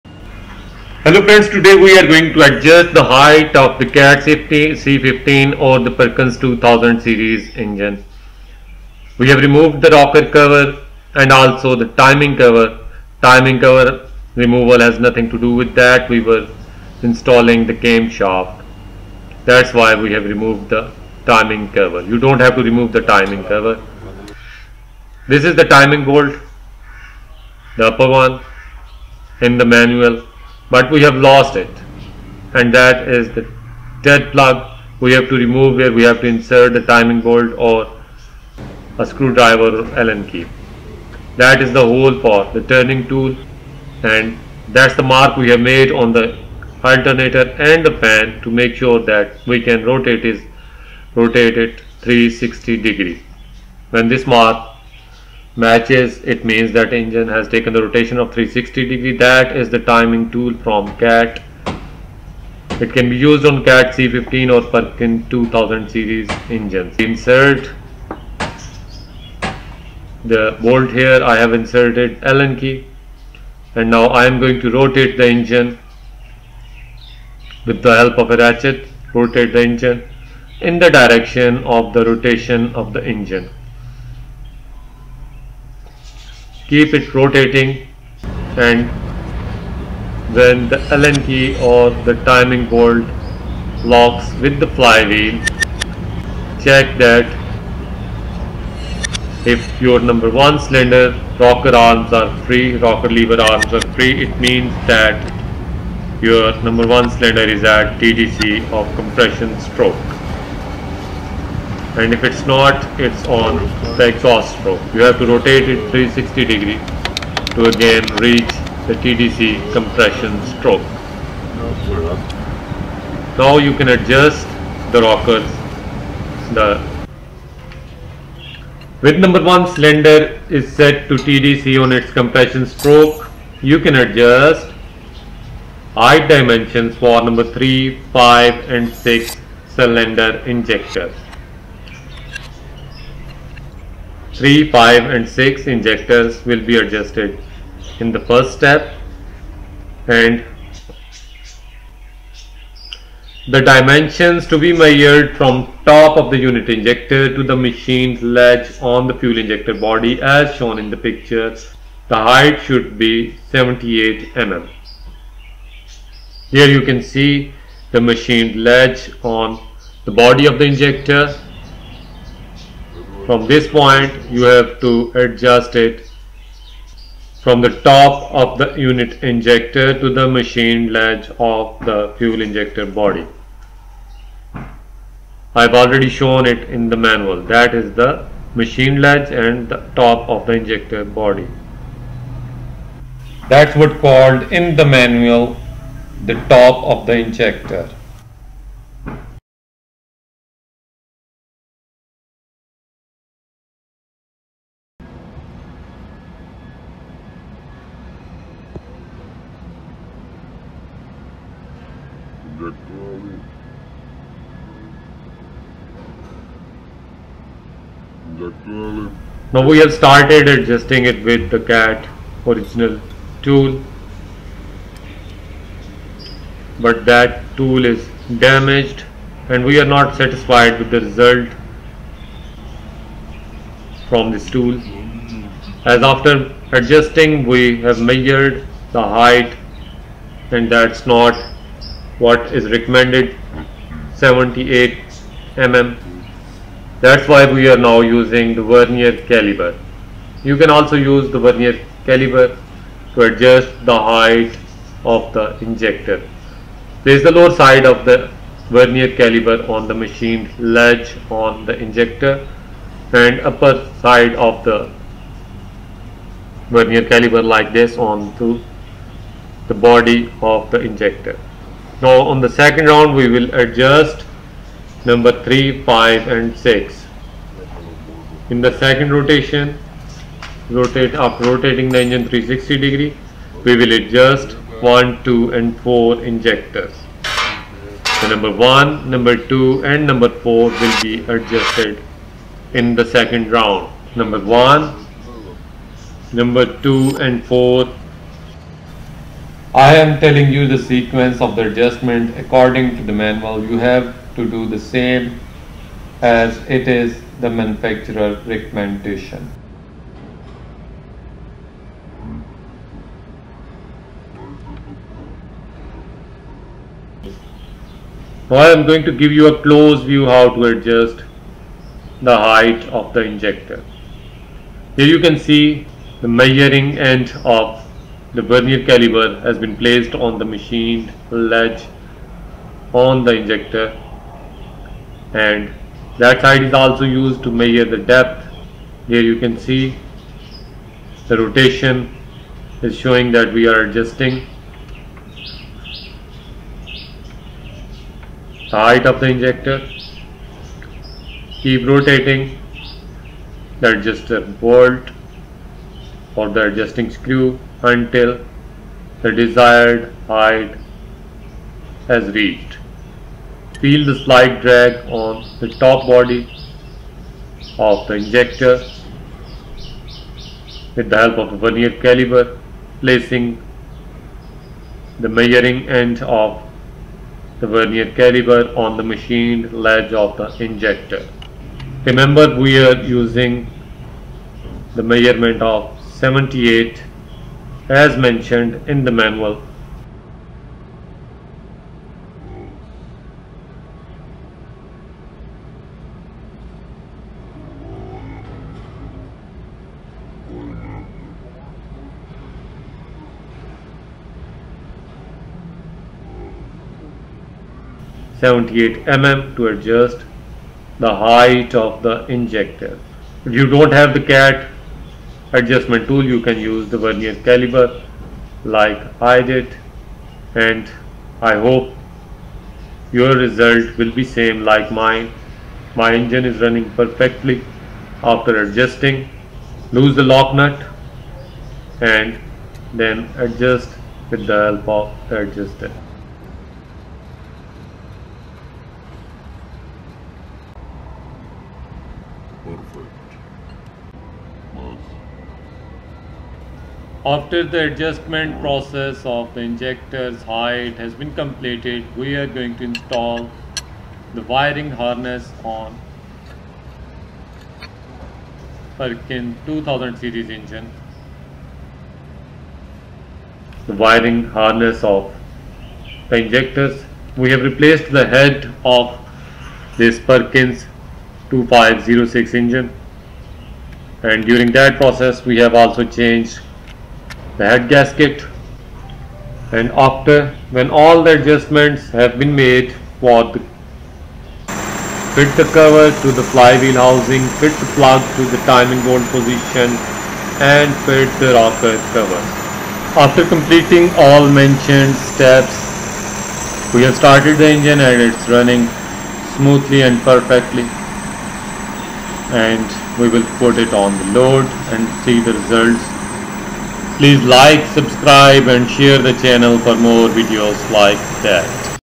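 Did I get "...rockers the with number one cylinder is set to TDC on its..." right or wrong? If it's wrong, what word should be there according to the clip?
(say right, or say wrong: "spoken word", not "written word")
right.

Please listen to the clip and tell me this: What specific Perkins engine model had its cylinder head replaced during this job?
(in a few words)
Perkins 2506.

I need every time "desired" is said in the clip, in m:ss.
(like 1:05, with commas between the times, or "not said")
5:59.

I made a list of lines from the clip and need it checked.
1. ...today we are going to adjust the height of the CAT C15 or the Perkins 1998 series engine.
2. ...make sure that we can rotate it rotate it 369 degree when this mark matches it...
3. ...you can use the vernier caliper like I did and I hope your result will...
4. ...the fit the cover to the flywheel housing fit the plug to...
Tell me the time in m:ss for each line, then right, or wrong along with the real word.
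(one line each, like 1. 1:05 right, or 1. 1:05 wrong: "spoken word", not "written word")
1. 0:01 wrong: "2000", not "1998"
2. 0:48 wrong: "360", not "369"
3. 6:56 right
4. 8:03 right.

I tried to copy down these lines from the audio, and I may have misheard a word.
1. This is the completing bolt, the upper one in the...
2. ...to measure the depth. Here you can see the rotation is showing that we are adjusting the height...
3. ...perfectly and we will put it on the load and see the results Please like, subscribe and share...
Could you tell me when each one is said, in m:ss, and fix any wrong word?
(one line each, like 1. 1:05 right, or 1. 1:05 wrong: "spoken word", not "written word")
1. 0:25 wrong: "timing", not "completing"
2. 5:37 right
3. 8:20 right.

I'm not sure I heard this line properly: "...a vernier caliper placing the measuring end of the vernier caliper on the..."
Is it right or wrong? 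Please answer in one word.
right.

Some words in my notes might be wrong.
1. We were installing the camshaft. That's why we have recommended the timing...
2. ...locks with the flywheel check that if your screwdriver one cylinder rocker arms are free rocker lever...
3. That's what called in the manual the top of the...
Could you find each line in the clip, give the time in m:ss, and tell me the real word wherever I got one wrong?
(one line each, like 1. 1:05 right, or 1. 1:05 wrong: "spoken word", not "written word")
1. 0:16 wrong: "removed", not "recommended"
2. 1:33 wrong: "number", not "screwdriver"
3. 3:13 right.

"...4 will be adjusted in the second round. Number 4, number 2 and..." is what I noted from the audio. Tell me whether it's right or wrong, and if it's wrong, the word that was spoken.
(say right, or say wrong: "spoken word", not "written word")
wrong: "1", not "4".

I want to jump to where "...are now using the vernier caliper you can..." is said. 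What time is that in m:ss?
4:07.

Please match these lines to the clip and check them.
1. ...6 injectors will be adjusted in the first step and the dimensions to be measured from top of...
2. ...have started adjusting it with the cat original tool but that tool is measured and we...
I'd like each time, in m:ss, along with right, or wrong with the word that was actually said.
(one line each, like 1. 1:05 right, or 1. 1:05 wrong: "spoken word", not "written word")
1. 2:25 right
2. 3:39 wrong: "damaged", not "measured".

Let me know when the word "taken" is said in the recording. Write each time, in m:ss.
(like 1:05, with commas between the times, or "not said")
0:57.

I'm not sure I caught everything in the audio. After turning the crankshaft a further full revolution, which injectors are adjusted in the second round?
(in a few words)
1, 2 and 4.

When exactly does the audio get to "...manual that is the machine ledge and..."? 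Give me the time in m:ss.
3:06.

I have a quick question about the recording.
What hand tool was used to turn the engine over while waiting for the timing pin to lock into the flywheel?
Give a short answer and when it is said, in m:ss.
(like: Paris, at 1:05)
ratchet, at 1:18.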